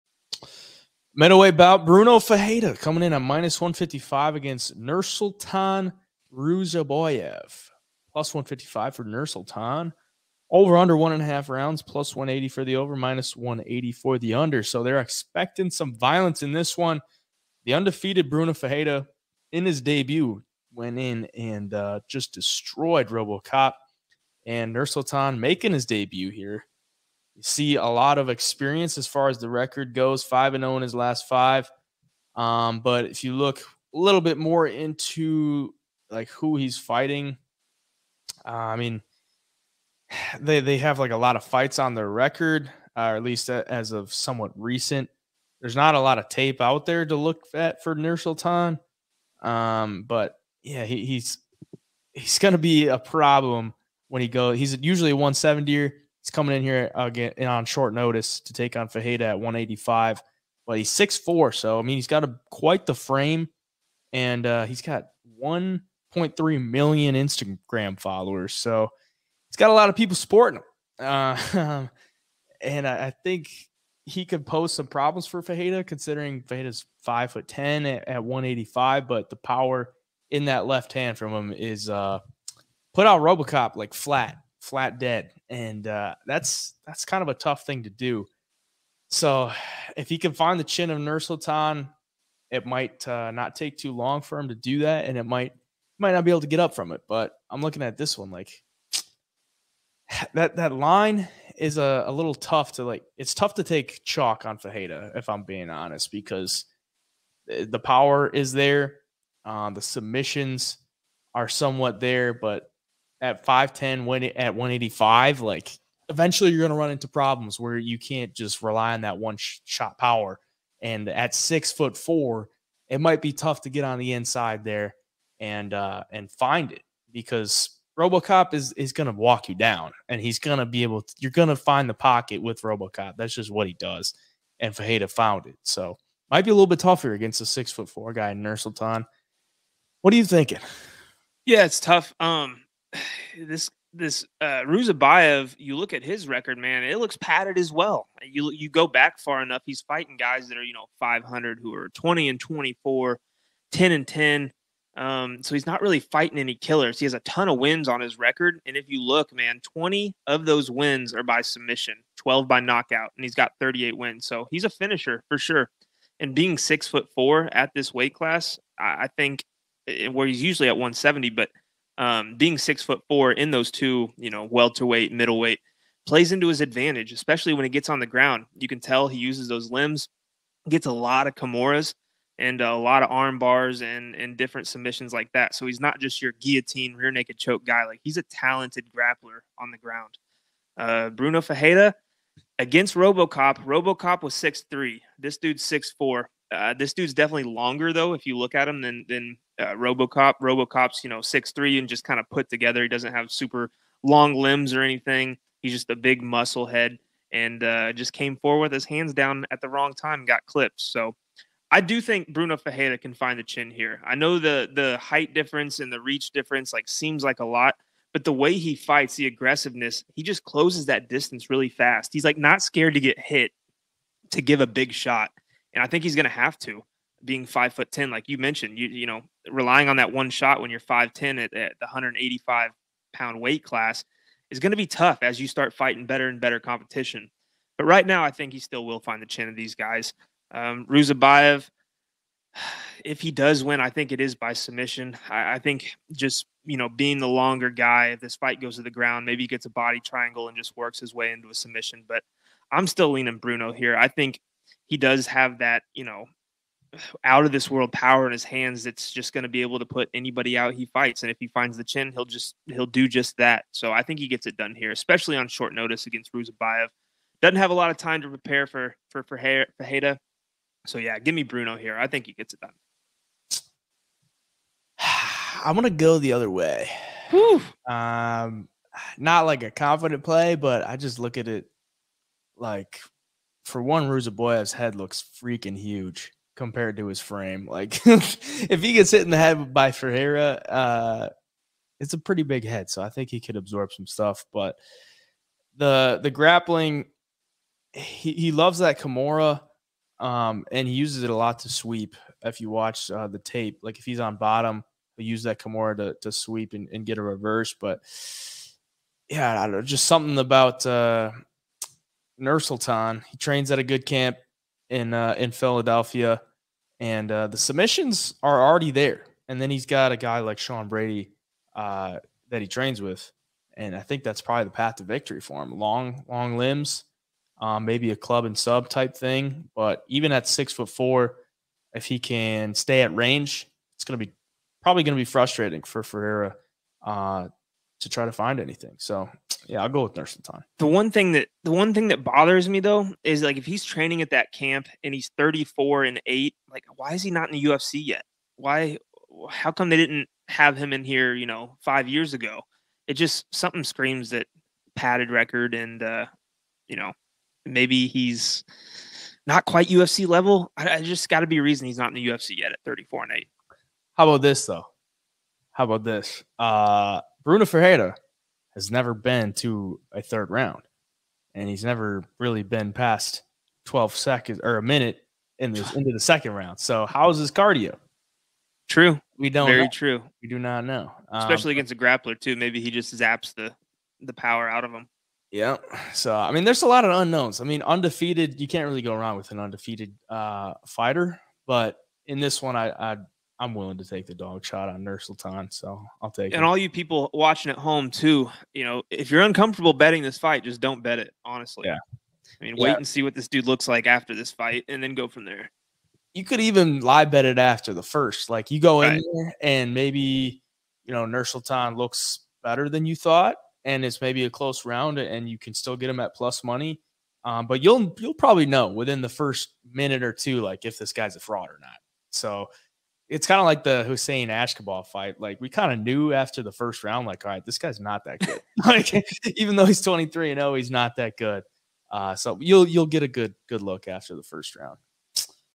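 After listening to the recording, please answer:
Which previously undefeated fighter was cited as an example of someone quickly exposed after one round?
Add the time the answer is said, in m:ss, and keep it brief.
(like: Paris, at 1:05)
Hussein Ashkabov, at 7:04.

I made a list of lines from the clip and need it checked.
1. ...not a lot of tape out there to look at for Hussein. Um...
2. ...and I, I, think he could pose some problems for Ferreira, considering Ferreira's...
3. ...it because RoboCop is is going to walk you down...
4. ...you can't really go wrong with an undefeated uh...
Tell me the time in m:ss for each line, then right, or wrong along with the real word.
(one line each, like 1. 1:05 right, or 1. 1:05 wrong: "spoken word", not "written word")
1. 0:45 wrong: "Nursulton", not "Hussein"
2. 1:12 right
3. 2:06 right
4. 6:28 right.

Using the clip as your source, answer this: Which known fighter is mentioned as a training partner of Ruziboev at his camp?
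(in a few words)
Sean Brady.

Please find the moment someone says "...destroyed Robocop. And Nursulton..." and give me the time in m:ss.
0:22.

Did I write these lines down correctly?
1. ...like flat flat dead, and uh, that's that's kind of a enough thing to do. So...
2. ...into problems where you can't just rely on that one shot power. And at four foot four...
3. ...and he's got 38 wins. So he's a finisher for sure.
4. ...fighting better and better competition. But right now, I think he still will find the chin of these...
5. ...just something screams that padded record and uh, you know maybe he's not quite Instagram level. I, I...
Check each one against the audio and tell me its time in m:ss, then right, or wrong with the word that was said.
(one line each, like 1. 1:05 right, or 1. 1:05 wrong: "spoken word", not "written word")
1. 1:23 wrong: "tough", not "enough"
2. 1:56 wrong: "six", not "four"
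3. 2:43 right
4. 3:55 right
5. 5:53 wrong: "UFC", not "Instagram".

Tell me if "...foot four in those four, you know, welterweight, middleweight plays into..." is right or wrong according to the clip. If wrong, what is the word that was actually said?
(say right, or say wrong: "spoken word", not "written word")
wrong: "two", not "four".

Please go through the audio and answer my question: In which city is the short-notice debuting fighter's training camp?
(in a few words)
Philadelphia.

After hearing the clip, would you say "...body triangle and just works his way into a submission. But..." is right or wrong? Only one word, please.
right.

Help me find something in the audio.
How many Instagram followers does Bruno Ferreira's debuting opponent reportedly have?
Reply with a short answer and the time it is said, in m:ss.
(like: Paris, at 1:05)
1.3 million, at 1:05.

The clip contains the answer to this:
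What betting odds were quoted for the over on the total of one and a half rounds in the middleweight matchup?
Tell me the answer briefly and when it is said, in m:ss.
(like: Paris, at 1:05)
+180, at 0:11.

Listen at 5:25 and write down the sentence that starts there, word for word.
Long, long limbs, um, maybe a club and sub type thing.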